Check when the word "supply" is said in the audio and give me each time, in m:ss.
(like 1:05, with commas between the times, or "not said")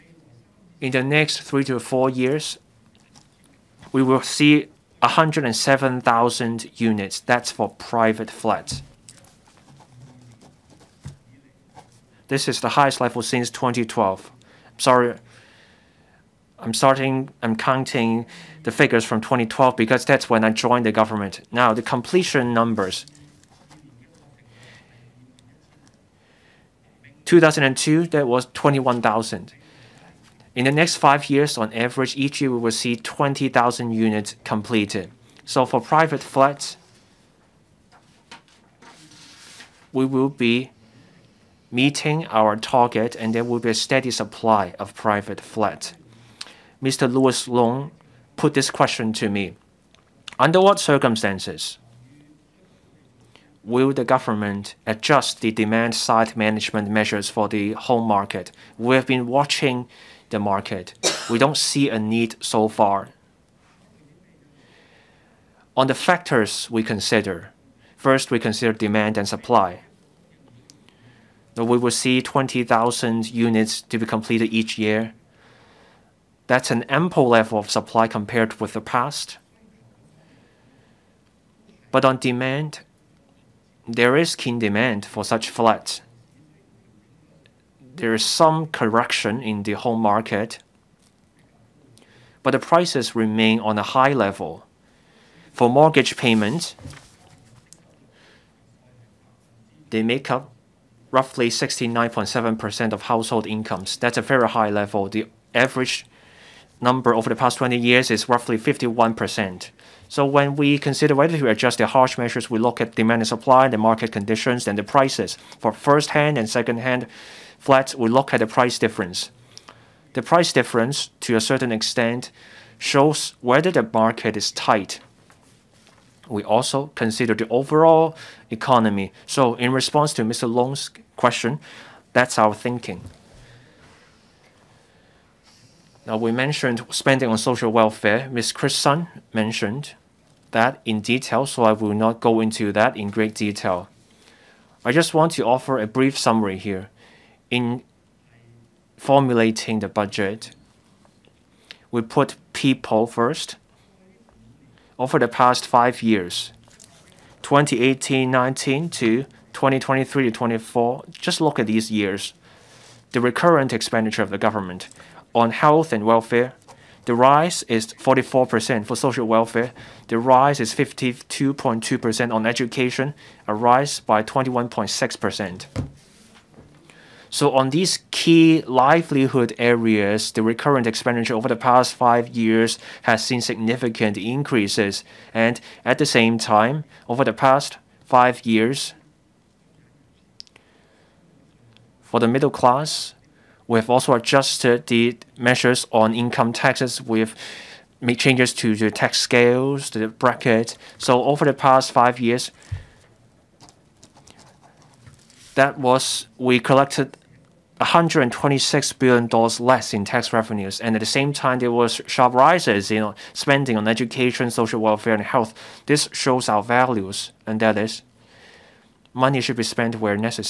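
0:44, 1:09, 1:17, 1:53.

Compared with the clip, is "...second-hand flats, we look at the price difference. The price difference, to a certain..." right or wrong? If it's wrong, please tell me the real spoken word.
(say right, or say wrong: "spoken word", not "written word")
right.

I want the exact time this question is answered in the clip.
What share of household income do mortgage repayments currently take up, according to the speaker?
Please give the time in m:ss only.
1:41.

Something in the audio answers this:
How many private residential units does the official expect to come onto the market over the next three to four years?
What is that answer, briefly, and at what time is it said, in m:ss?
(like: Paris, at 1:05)
107,000, at 0:05.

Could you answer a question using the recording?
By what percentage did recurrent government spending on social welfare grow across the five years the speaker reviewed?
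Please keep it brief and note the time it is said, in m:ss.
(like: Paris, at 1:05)
52.2%, at 2:50.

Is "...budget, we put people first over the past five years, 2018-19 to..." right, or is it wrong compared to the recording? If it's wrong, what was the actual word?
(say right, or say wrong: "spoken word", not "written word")
right.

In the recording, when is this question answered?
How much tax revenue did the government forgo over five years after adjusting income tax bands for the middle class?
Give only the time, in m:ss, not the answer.
3:27.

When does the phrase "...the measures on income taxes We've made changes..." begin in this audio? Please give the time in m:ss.
3:14.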